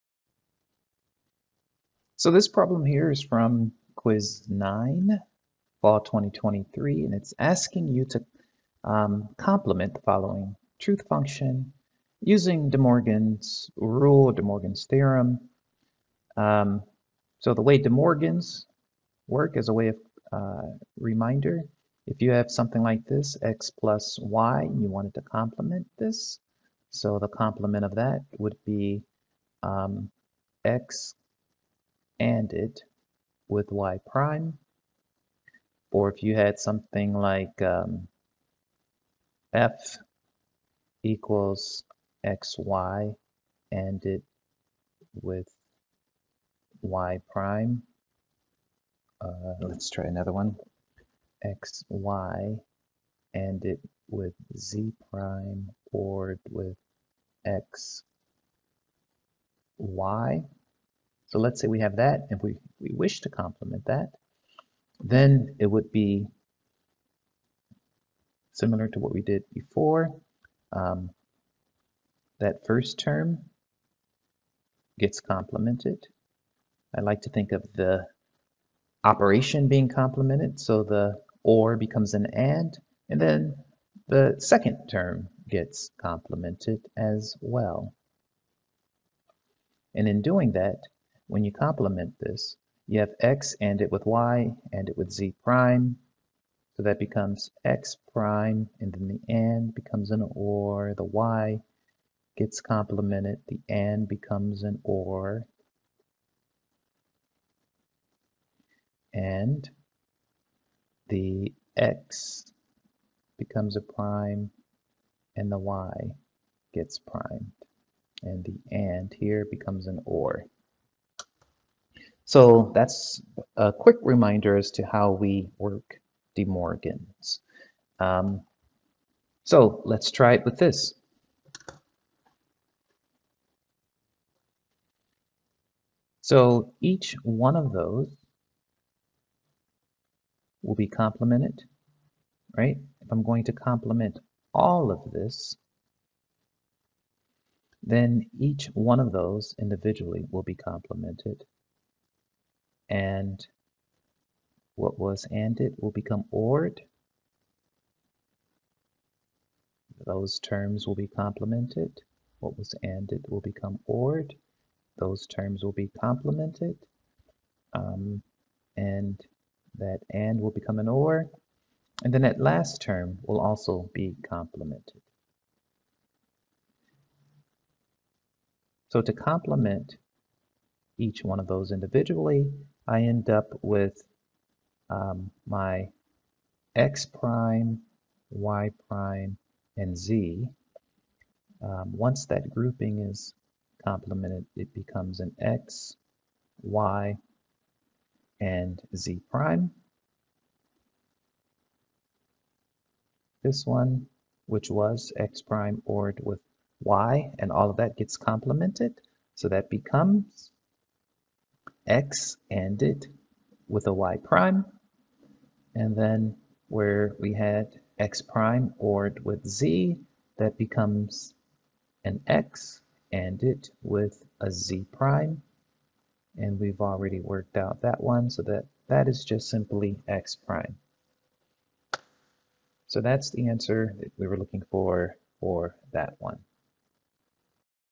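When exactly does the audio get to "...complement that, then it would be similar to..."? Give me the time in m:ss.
1:03.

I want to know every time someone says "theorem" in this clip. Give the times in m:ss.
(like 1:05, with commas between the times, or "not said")
0:14.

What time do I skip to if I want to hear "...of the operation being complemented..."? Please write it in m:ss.
1:17.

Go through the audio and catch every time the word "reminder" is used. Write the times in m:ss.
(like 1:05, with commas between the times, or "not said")
0:20, 2:04.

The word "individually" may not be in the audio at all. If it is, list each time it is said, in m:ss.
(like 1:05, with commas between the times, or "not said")
2:29, 3:01.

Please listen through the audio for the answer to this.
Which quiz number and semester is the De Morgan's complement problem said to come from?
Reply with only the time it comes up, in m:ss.
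0:03.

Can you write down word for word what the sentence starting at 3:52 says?
So that's the answer that we were looking for for that one.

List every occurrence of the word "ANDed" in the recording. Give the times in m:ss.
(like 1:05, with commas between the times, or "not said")
2:35, 2:42.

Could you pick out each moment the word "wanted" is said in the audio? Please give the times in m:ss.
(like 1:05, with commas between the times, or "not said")
0:24.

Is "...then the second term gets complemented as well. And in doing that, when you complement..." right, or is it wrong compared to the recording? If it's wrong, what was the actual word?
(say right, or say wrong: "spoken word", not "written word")
right.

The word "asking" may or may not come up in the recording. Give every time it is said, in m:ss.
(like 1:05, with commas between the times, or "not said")
0:07.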